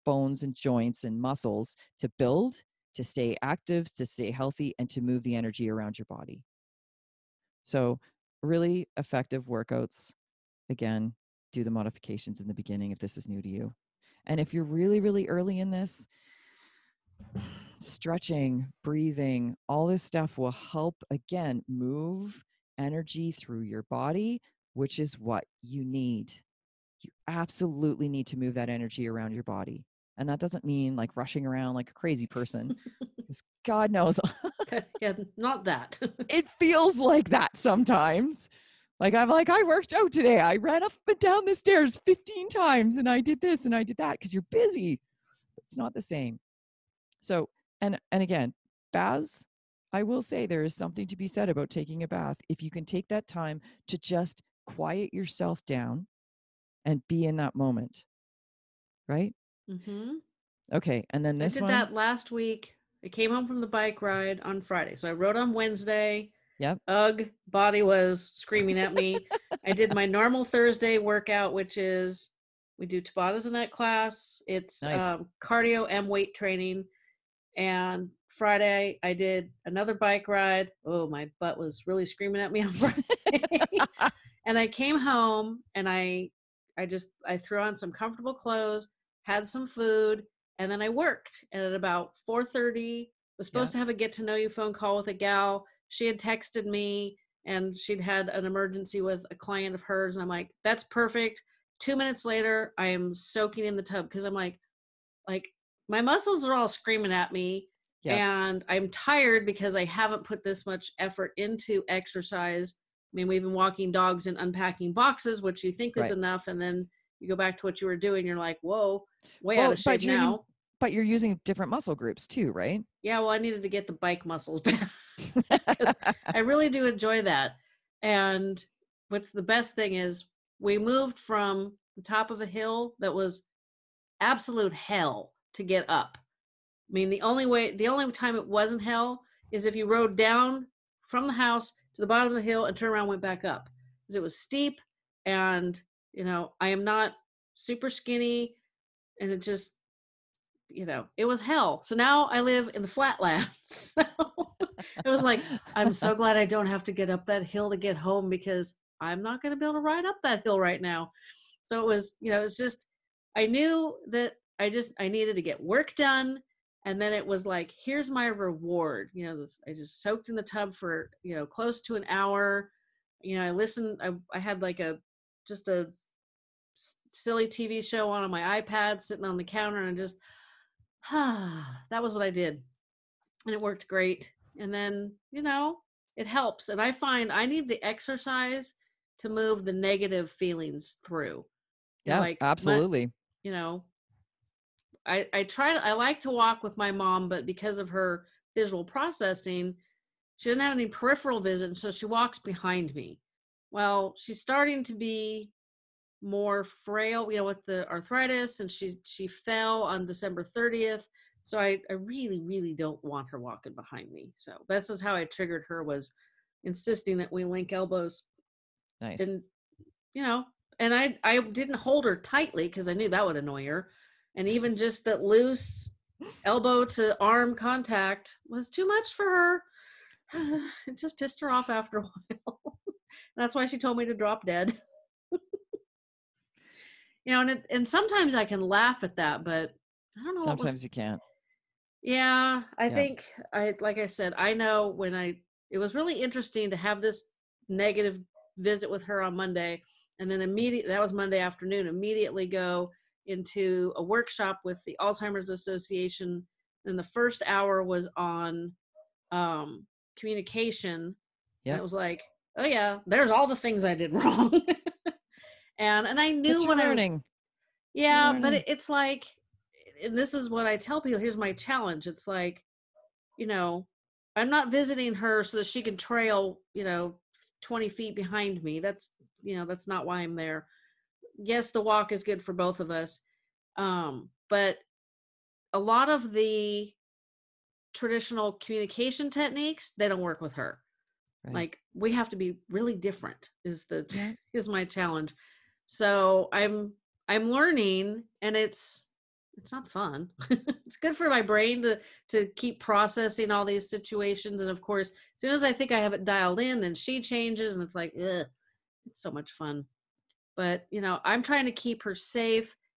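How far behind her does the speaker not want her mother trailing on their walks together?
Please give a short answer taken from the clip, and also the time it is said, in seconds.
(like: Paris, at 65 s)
20 feet, at 277 s.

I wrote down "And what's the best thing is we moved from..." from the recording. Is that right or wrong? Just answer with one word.
right.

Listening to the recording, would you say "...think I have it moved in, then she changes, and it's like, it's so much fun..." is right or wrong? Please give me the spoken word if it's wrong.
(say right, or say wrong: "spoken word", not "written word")
wrong: "dialed", not "moved".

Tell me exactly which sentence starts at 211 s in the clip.
So I, I really, really don't want her walking behind me.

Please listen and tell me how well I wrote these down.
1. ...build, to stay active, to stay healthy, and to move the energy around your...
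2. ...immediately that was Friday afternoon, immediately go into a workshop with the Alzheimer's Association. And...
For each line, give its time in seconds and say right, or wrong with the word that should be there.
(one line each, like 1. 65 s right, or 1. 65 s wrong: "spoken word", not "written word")
1. 2 s right
2. 250 s wrong: "Monday", not "Friday".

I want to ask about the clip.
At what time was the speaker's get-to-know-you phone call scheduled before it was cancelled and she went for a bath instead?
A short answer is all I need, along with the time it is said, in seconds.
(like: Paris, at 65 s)
4:30, at 92 s.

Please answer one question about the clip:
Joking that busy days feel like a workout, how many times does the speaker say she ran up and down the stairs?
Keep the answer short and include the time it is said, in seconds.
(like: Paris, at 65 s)
15, at 42 s.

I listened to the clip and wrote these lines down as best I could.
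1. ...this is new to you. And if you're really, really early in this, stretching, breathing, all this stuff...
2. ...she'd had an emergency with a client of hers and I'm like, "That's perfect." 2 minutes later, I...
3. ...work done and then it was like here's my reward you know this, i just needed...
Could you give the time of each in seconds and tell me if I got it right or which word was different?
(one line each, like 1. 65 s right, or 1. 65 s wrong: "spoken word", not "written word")
1. 12 s right
2. 97 s right
3. 165 s wrong: "soaked", not "needed".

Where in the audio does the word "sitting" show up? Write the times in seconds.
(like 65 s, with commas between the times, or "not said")
179 s.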